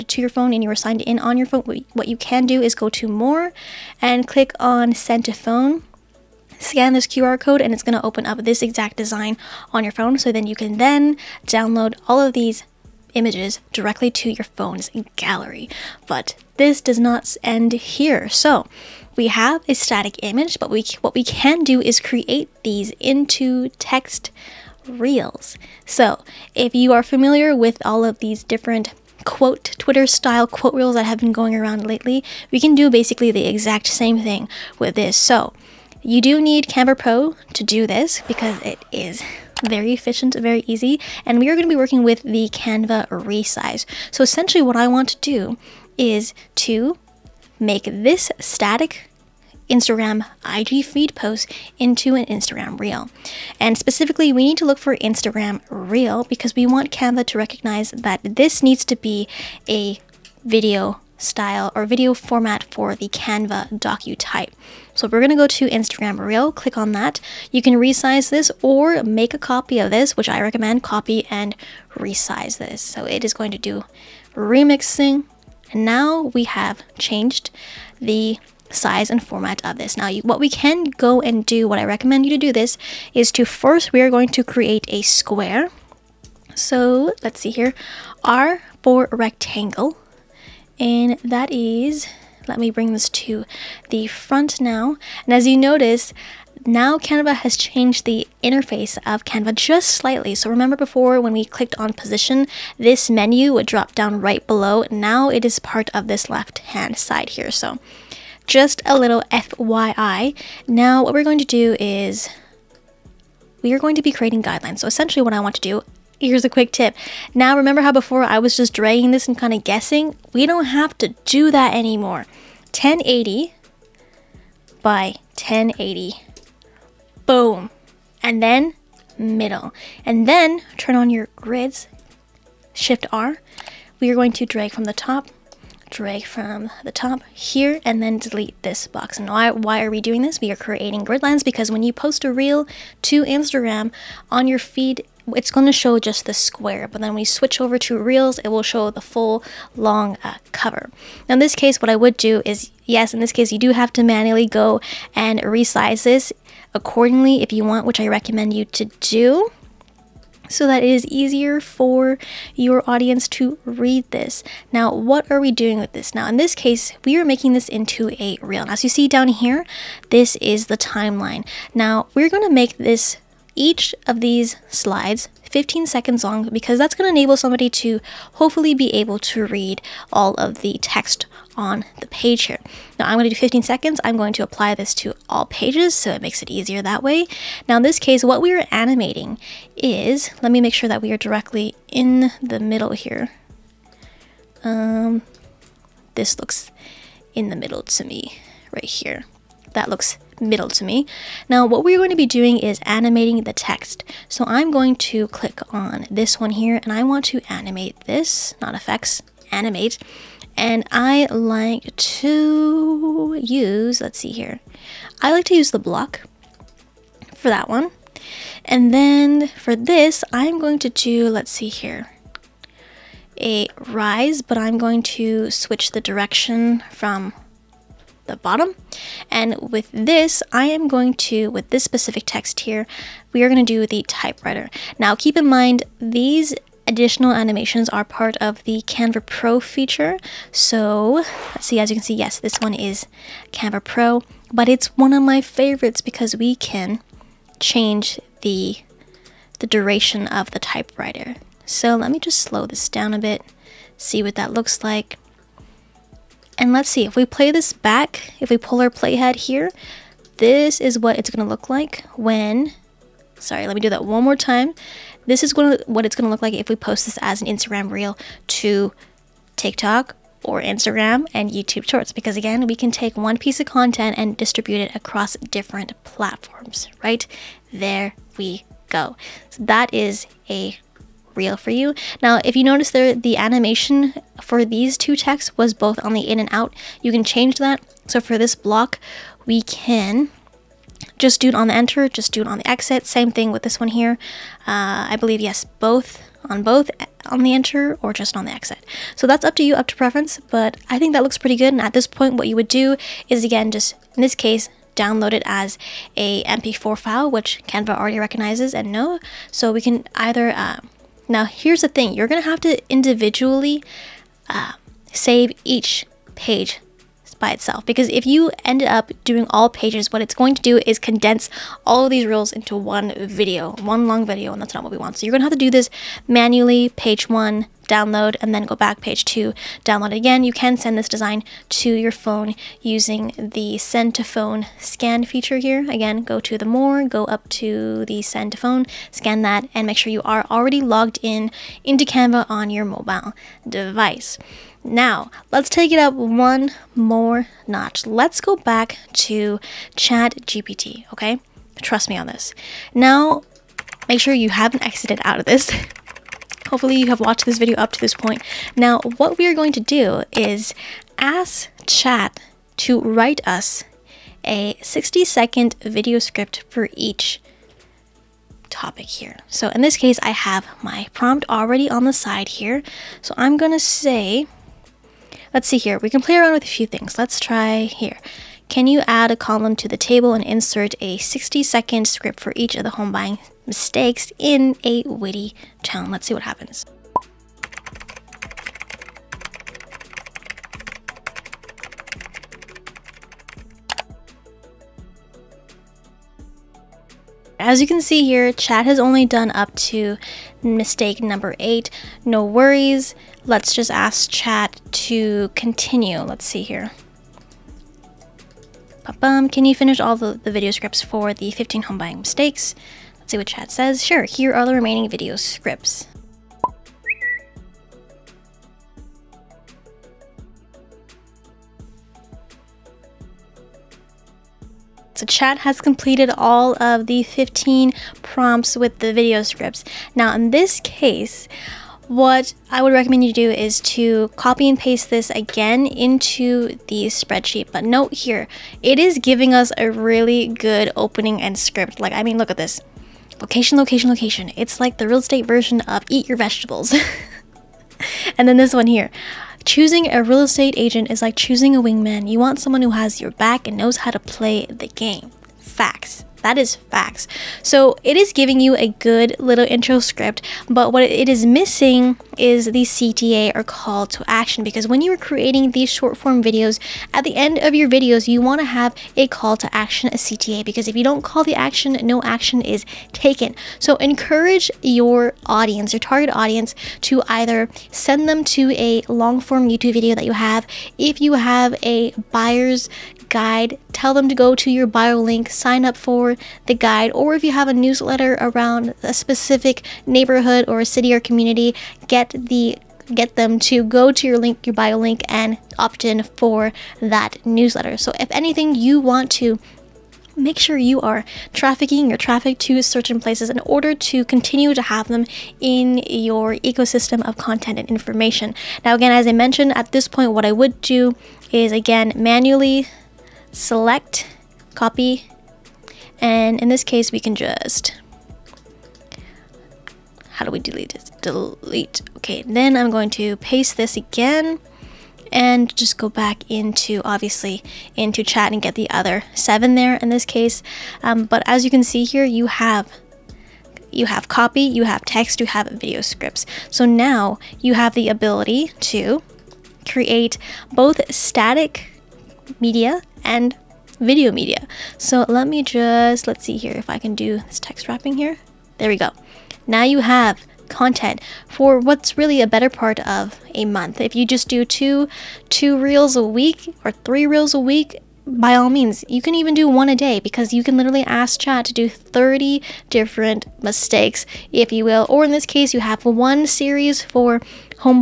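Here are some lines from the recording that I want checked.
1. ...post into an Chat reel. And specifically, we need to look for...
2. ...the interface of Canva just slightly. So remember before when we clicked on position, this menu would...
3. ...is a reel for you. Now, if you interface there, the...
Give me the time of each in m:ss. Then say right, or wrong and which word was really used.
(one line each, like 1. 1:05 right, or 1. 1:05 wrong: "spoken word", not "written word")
1. 0:51 wrong: "Instagram", not "Chat"
2. 1:38 right
3. 4:39 wrong: "notice", not "interface".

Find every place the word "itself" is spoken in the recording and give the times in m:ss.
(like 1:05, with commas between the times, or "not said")
5:17.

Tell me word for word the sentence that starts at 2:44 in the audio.
Now, what are we doing with this?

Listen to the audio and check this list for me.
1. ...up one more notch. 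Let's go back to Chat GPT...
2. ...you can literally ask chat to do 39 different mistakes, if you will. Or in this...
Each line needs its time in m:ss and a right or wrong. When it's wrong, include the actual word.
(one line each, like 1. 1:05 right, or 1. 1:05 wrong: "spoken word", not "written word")
1. 5:45 right
2. 9:20 wrong: "30", not "39".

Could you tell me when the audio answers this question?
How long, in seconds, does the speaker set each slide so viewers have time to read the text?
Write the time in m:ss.
2:55.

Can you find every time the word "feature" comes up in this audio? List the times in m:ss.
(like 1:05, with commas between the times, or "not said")
3:59, 5:35.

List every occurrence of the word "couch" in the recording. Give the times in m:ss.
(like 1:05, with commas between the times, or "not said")
not said.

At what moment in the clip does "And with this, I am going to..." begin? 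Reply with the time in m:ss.
3:49.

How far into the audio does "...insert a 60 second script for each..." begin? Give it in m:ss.
6:20.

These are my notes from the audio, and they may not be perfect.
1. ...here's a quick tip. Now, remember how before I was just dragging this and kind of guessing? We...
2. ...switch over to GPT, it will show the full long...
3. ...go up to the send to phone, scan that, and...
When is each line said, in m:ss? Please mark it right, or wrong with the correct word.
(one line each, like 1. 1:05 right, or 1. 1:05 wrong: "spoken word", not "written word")
1. 1:56 right
2. 2:27 wrong: "Reels", not "GPT"
3. 5:37 right.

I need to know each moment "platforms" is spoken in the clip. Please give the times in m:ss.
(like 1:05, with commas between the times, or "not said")
4:36.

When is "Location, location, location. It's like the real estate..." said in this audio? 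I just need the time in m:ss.
7:23.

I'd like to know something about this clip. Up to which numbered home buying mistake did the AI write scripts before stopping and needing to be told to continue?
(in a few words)
8.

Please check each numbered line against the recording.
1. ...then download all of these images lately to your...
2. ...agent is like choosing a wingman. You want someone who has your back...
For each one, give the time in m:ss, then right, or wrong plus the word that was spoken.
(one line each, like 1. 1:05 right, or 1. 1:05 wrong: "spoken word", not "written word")
1. 0:10 wrong: "directly", not "lately"
2. 7:30 right.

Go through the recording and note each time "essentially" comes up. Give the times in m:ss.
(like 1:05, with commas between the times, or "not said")
0:44, 1:54.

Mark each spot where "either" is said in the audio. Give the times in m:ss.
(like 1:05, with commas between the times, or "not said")
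5:10, 7:57.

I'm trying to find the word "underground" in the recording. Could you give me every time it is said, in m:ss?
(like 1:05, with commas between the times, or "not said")
not said.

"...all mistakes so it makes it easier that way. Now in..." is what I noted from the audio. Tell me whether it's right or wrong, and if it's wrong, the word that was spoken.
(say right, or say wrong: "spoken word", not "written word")
wrong: "pages", not "mistakes".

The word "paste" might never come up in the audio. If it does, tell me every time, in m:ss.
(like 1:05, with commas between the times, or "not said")
7:14, 8:43.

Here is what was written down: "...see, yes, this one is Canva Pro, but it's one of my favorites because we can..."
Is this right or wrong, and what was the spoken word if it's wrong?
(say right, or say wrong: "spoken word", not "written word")
right.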